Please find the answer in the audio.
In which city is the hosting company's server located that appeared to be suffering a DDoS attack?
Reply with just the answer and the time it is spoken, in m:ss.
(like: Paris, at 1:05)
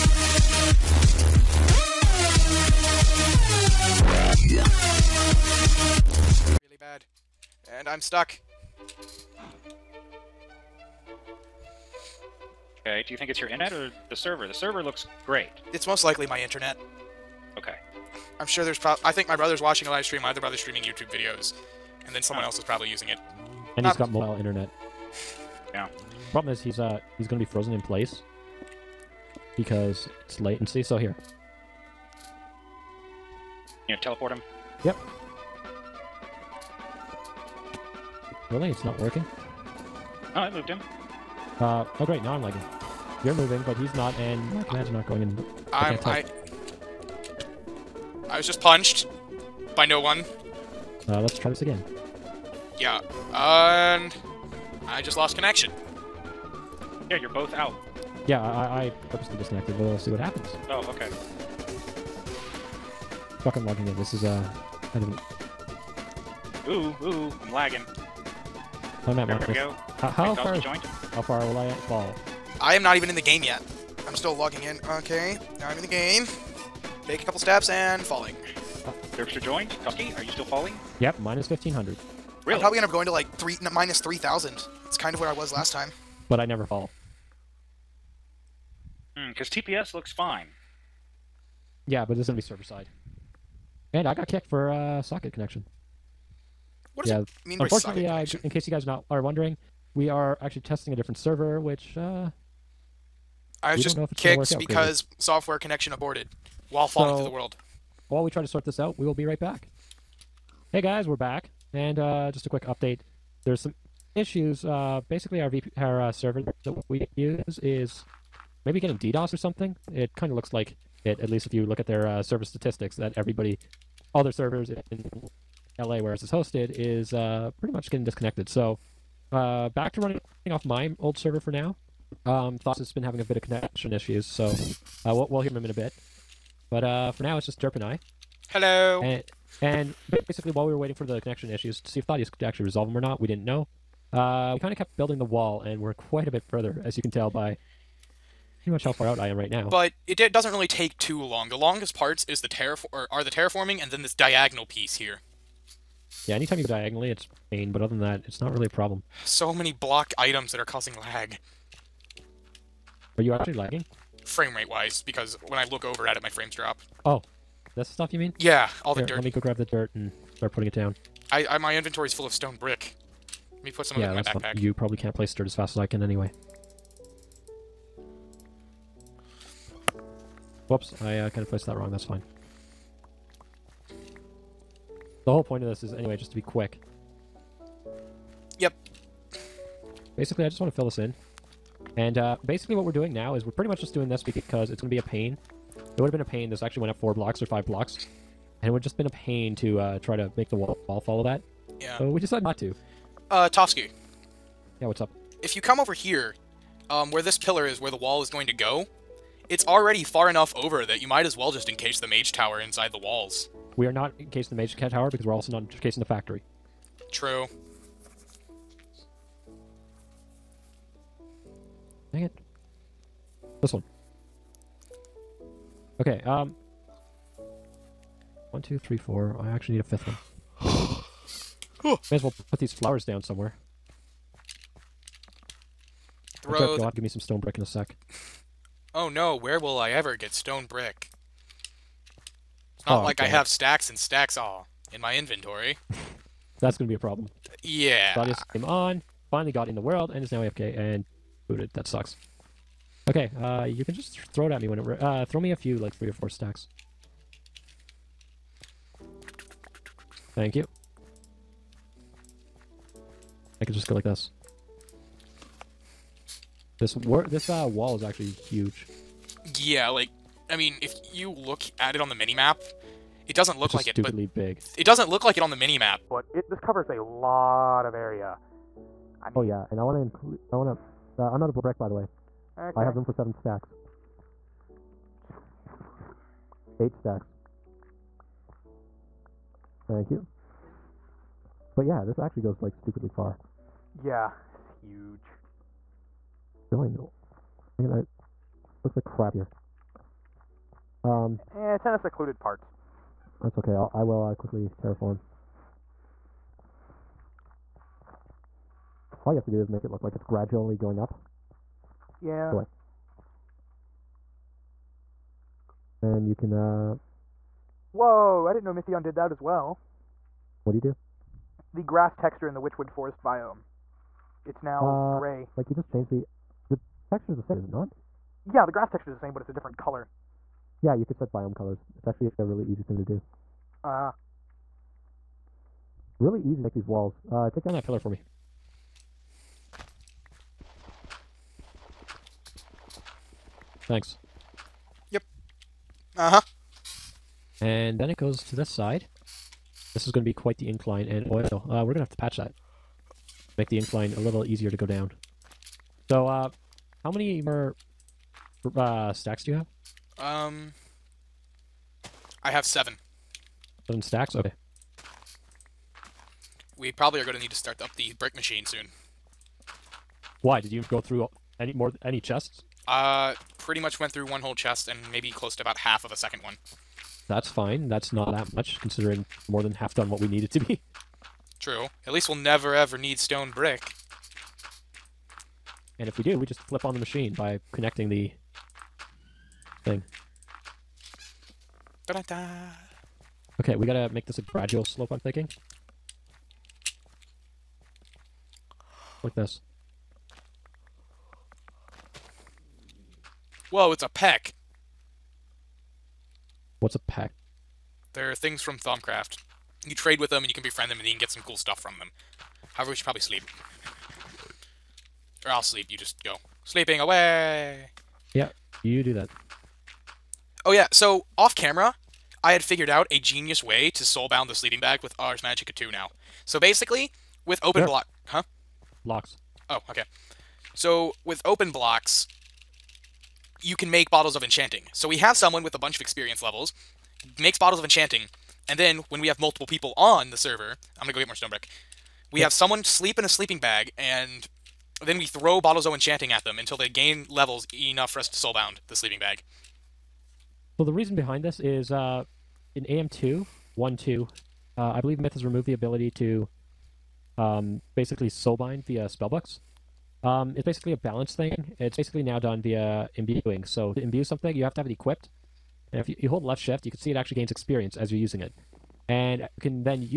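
LA, at 2:05.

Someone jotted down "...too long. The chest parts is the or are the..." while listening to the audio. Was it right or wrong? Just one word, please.
wrong.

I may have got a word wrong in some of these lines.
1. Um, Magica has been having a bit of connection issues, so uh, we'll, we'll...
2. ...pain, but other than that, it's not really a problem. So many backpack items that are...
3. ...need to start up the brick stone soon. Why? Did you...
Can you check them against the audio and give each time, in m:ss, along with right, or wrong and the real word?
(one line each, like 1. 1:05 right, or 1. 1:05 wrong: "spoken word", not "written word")
1. 2:12 wrong: "Thoughts", not "Magica"
2. 2:37 wrong: "block", not "backpack"
3. 6:07 wrong: "machine", not "stone".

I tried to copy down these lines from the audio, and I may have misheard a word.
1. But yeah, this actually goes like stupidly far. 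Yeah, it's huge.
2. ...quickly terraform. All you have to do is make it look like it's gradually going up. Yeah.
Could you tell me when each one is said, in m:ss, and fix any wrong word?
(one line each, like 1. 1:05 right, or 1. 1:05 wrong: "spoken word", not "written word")
1. 4:51 right
2. 5:04 right.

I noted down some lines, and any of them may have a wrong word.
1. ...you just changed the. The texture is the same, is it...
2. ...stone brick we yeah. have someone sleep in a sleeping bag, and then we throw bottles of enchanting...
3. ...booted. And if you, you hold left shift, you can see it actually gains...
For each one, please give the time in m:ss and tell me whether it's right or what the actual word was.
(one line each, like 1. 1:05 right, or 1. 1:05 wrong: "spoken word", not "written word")
1. 5:25 right
2. 7:21 right
3. 7:44 wrong: "equipped", not "booted".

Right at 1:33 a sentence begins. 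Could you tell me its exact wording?
And I got kicked for uh, socket connection.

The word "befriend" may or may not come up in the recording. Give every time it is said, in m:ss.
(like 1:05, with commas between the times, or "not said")
6:50.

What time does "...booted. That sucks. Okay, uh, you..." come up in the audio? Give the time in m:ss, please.
4:11.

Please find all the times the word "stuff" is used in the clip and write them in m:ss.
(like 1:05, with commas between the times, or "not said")
2:47, 6:51.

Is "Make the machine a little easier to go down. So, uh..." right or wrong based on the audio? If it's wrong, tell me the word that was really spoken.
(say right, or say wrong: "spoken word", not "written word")
wrong: "incline", not "machine".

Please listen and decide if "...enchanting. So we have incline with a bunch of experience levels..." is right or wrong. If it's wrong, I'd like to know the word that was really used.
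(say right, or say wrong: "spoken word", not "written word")
wrong: "someone", not "incline".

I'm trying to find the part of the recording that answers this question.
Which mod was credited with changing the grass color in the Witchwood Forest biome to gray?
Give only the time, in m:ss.
5:18.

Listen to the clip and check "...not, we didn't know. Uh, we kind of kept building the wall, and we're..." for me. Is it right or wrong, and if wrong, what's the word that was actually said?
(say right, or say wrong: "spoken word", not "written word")
right.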